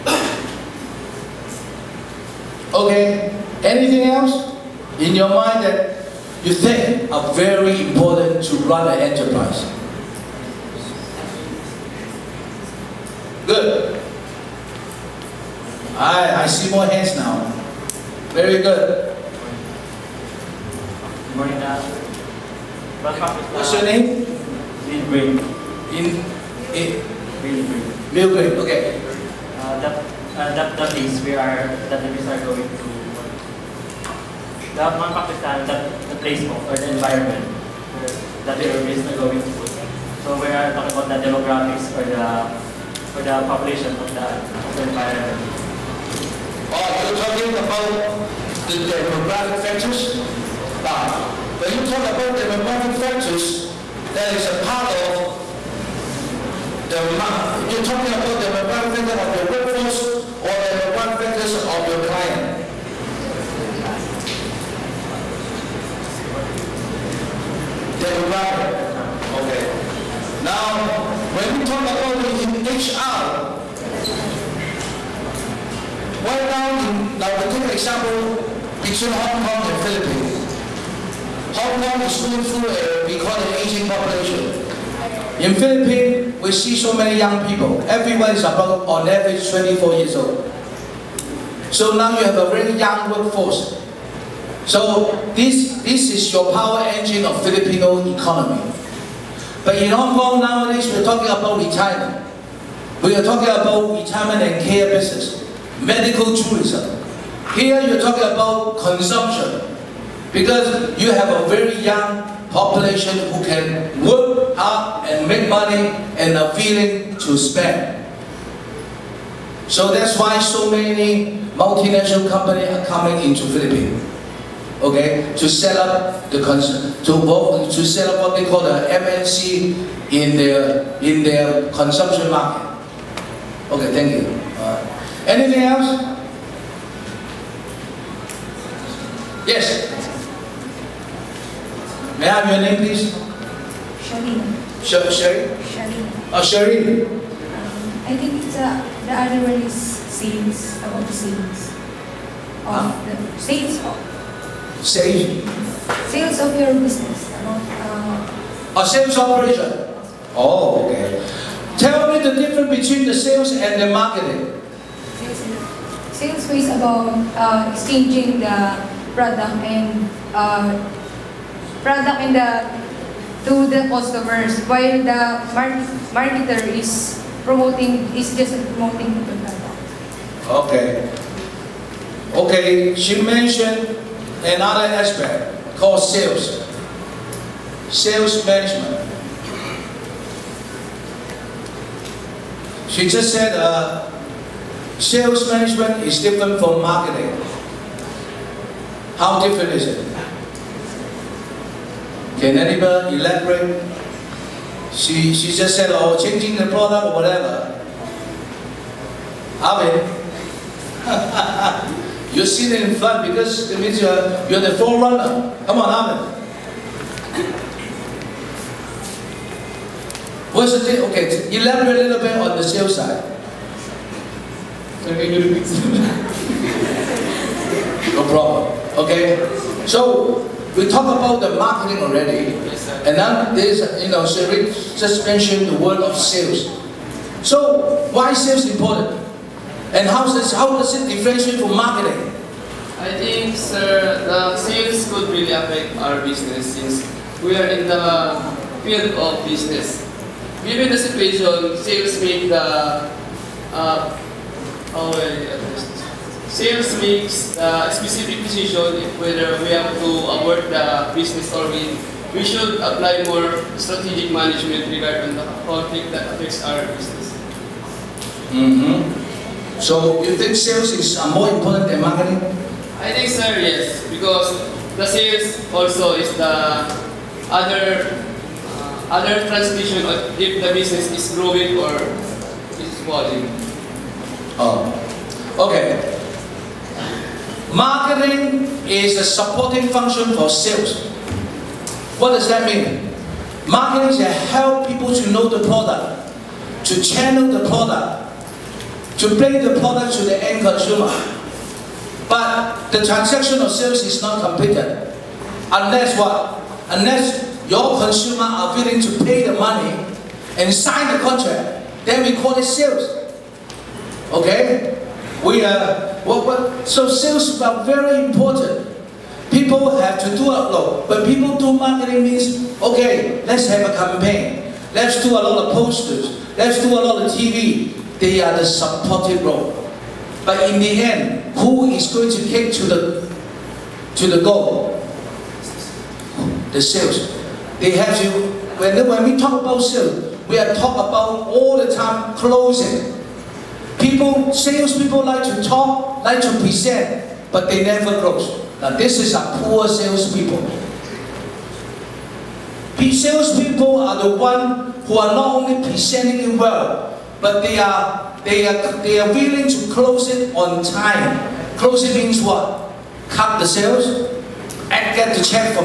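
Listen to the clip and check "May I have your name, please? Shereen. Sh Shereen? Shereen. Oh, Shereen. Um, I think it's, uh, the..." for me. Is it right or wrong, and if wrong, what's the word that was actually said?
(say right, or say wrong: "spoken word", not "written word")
right.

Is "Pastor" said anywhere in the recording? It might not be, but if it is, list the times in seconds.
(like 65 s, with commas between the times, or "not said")
21 s.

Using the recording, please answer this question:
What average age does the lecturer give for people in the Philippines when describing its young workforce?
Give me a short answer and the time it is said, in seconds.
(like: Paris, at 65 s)
24, at 89 s.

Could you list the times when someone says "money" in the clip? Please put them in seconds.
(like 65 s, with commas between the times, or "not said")
115 s, 309 s.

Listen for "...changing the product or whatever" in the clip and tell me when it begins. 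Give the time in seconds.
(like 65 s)
206 s.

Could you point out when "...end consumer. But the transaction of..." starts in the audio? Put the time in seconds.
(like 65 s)
300 s.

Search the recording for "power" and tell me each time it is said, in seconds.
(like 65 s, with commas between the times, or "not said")
96 s.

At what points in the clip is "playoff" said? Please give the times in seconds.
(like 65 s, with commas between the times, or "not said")
not said.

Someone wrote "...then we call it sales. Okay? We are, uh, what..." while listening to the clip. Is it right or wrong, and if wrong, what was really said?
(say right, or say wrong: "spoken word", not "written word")
right.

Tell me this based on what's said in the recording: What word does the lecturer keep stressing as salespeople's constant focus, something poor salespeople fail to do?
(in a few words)
closing.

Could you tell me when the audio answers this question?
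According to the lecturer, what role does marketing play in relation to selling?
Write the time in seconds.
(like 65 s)
289 s.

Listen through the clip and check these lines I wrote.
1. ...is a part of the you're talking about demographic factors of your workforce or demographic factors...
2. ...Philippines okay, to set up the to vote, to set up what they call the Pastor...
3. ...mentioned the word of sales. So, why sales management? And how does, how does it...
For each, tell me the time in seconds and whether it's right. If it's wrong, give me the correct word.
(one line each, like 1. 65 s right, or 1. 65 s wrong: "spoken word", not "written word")
1. 54 s right
2. 123 s wrong: "MNC", not "Pastor"
3. 235 s wrong: "important", not "management".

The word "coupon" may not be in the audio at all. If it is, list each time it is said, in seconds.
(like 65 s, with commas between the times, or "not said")
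not said.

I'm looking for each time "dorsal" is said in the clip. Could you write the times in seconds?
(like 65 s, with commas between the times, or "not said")
not said.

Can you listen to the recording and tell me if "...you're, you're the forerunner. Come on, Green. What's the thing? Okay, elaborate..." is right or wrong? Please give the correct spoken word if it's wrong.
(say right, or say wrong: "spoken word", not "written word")
wrong: "Amen", not "Green".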